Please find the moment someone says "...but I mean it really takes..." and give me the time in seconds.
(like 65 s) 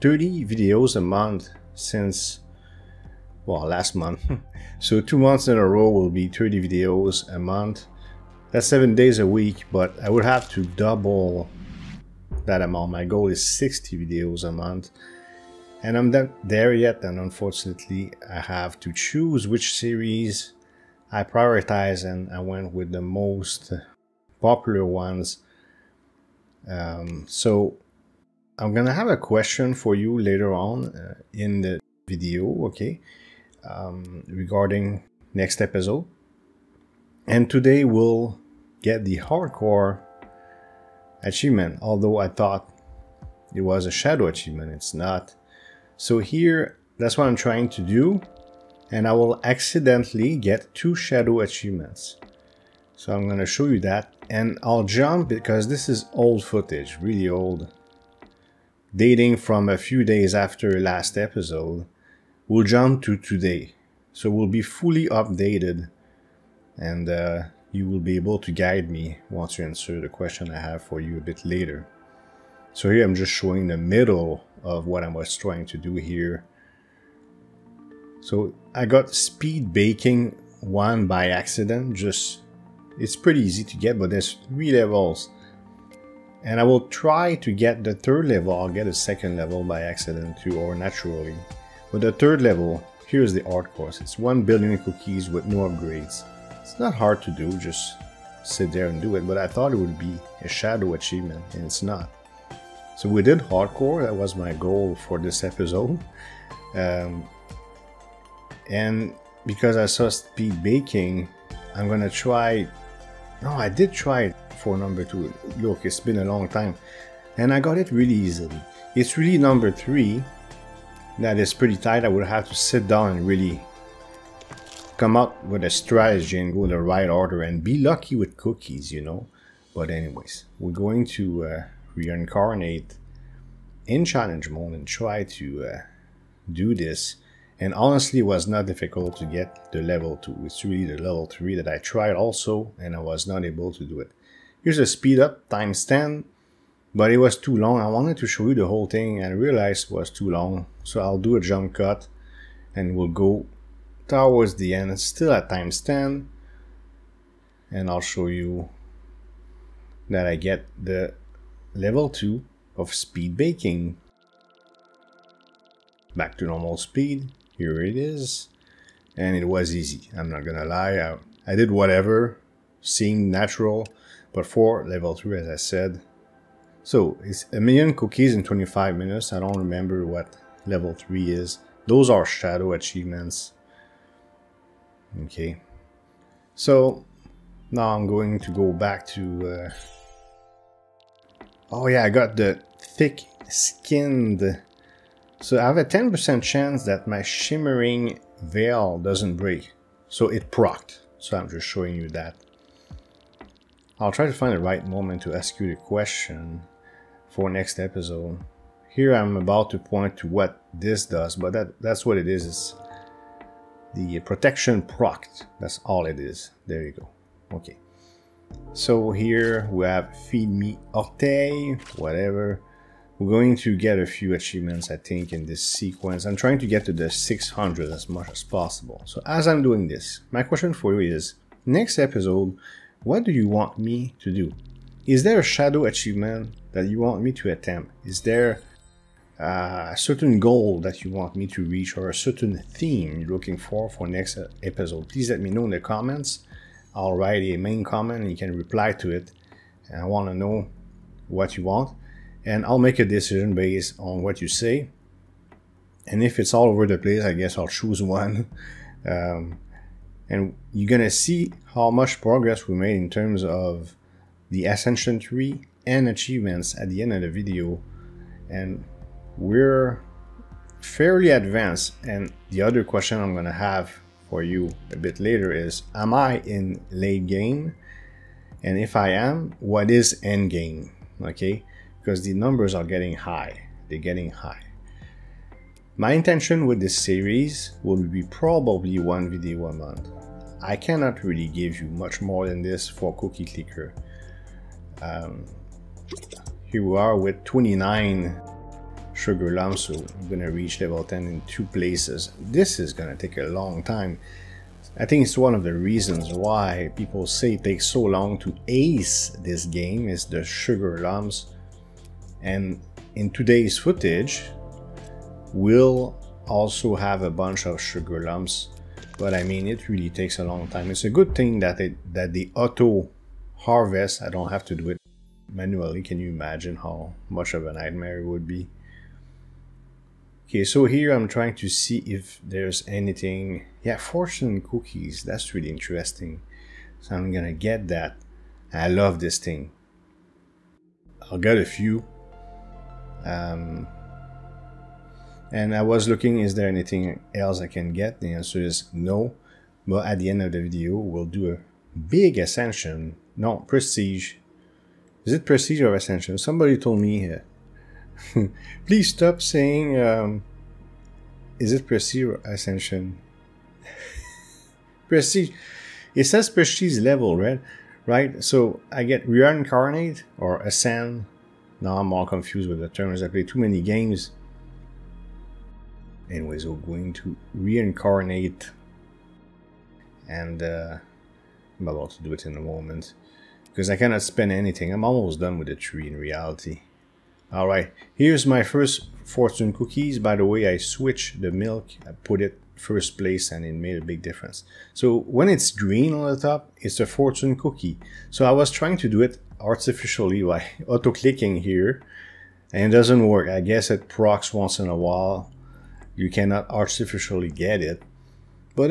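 319 s.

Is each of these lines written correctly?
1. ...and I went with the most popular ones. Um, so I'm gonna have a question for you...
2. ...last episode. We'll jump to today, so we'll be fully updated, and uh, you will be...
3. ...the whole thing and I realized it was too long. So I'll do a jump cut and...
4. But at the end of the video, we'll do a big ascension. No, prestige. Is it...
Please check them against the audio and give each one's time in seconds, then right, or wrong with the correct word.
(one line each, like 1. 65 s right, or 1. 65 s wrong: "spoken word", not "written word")
1. 22 s right
2. 60 s right
3. 148 s right
4. 349 s right.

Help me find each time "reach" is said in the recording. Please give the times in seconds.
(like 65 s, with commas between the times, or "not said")
241 s, 300 s.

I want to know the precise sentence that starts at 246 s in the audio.
I'll write a main comment and you can reply to it.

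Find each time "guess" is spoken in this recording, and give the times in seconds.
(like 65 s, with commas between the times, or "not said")
257 s, 403 s.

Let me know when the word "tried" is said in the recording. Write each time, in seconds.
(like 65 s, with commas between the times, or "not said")
141 s.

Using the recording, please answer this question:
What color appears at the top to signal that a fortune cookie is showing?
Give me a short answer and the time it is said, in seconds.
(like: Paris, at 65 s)
green, at 395 s.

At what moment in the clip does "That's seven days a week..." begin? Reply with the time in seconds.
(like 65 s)
8 s.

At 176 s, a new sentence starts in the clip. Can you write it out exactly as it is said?
So it's a million cookies in 25 minutes, I don't remember what level 3 is.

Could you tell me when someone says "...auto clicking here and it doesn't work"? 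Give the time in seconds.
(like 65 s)
400 s.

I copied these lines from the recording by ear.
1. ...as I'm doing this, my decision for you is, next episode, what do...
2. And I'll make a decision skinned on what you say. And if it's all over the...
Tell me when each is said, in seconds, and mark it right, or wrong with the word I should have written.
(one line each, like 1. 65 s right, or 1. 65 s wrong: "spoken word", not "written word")
1. 229 s wrong: "question", not "decision"
2. 252 s wrong: "based", not "skinned".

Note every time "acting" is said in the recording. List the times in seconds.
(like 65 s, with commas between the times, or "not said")
not said.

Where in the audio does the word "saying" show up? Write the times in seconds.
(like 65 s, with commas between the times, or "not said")
359 s.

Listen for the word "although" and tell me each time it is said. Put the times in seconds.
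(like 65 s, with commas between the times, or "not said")
41 s.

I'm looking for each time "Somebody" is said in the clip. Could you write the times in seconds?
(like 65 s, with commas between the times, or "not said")
356 s.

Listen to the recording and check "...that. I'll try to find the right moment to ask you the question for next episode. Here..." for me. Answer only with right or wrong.
right.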